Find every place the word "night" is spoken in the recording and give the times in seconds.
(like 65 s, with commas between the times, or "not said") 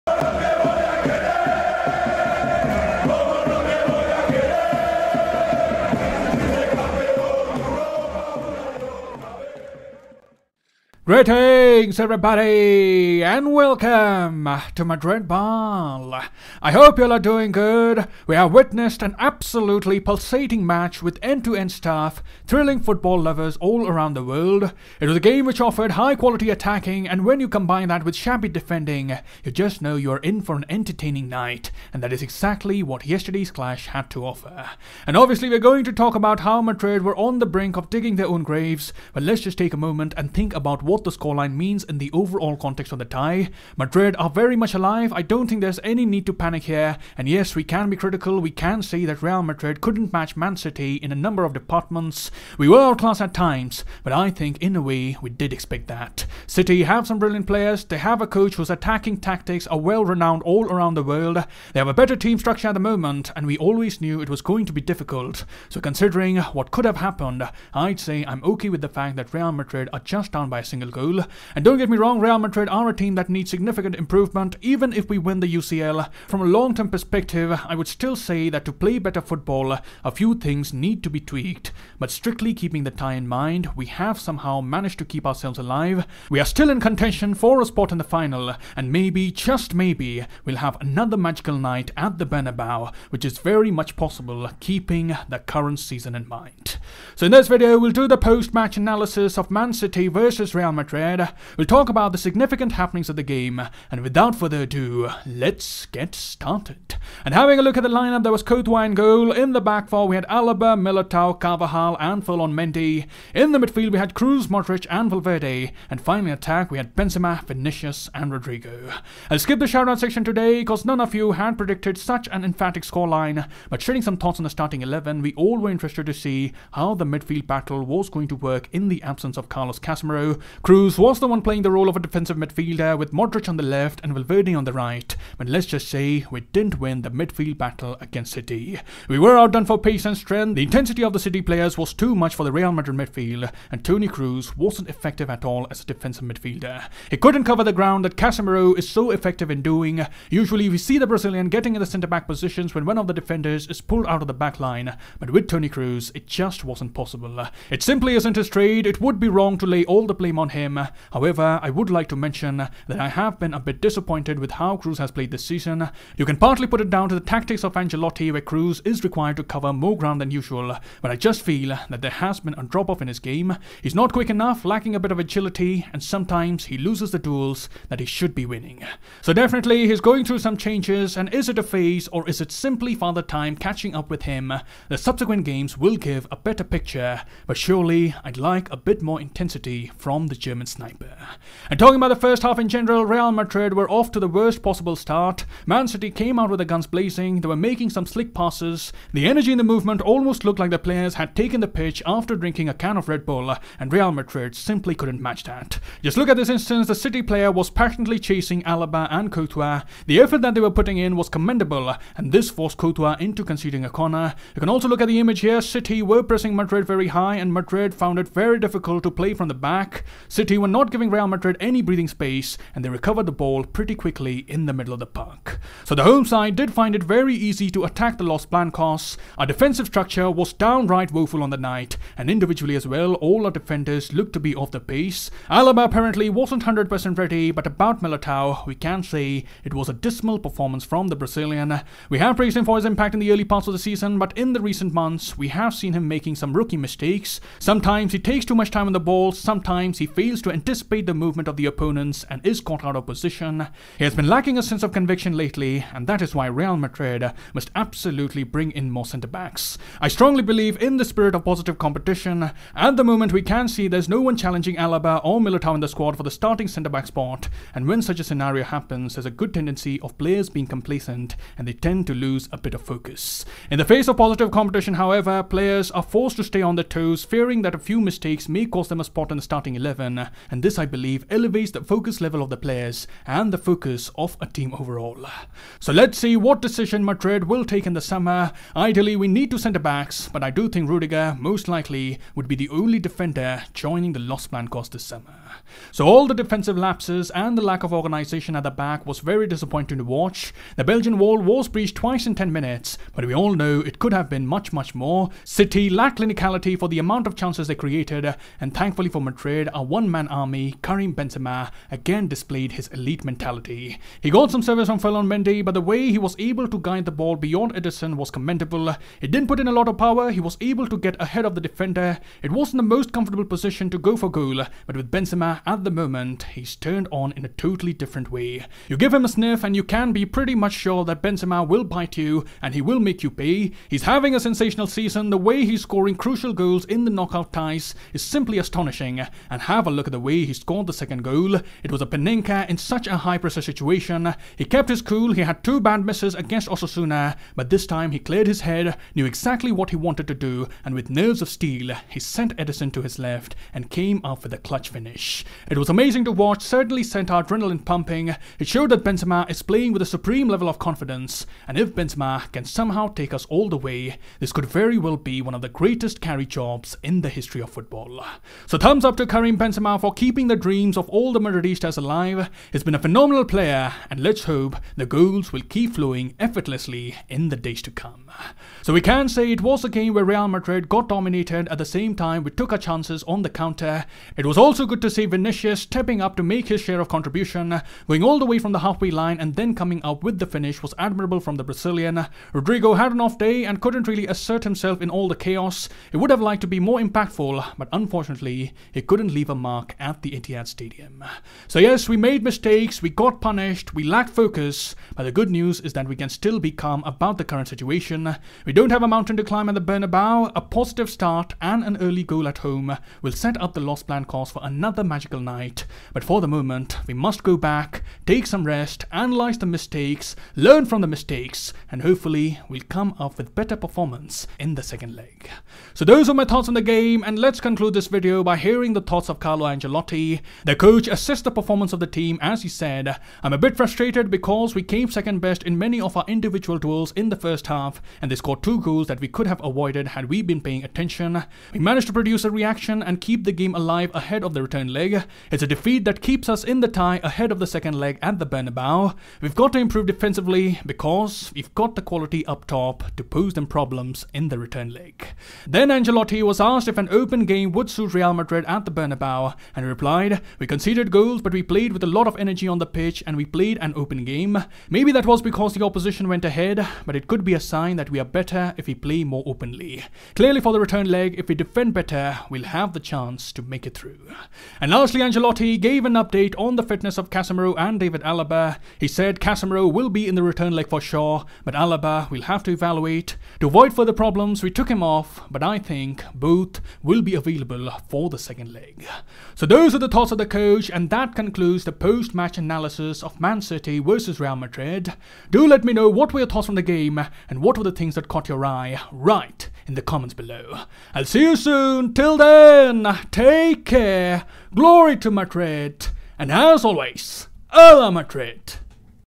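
31 s, 91 s, 231 s, 415 s.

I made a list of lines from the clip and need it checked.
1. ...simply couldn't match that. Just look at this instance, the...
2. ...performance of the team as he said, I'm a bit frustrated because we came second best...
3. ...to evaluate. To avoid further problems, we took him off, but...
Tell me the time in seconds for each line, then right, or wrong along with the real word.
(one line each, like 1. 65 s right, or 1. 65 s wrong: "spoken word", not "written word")
1. 204 s right
2. 431 s right
3. 482 s right.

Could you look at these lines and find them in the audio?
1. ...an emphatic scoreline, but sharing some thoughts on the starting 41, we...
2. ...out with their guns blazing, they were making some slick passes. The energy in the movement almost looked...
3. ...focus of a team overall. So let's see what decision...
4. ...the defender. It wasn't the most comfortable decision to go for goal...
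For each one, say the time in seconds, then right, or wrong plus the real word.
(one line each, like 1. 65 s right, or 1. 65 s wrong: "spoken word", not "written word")
1. 122 s wrong: "11", not "41"
2. 196 s right
3. 283 s right
4. 321 s wrong: "position", not "decision".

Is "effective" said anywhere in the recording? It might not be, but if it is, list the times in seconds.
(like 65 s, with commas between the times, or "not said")
144 s, 149 s.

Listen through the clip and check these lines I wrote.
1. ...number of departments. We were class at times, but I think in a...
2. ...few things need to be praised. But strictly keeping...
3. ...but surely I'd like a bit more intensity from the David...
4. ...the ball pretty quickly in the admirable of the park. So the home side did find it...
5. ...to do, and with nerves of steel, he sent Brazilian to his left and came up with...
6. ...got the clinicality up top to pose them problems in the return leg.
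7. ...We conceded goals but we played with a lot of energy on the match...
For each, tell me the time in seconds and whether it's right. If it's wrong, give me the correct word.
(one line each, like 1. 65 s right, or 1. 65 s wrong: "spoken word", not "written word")
1. 51 s right
2. 80 s wrong: "tweaked", not "praised"
3. 187 s wrong: "German", not "David"
4. 223 s wrong: "middle", not "admirable"
5. 350 s wrong: "Ederson", not "Brazilian"
6. 451 s wrong: "quality", not "clinicality"
7. 460 s wrong: "pitch", not "match".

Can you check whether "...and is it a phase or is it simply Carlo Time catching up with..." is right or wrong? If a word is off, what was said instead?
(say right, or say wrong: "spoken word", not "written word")
wrong: "Father", not "Carlo".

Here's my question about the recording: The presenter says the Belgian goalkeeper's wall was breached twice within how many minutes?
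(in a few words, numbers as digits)
10 minutes.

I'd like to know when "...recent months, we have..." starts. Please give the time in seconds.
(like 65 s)
244 s.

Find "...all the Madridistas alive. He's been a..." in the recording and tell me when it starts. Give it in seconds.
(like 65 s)
371 s.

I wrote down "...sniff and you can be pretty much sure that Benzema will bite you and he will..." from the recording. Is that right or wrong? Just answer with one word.
right.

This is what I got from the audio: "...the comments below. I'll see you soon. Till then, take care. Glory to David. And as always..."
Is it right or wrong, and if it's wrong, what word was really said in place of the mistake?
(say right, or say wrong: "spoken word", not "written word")
wrong: "Madrid", not "David".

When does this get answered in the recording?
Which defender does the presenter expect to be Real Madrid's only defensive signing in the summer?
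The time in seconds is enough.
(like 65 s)
290 s.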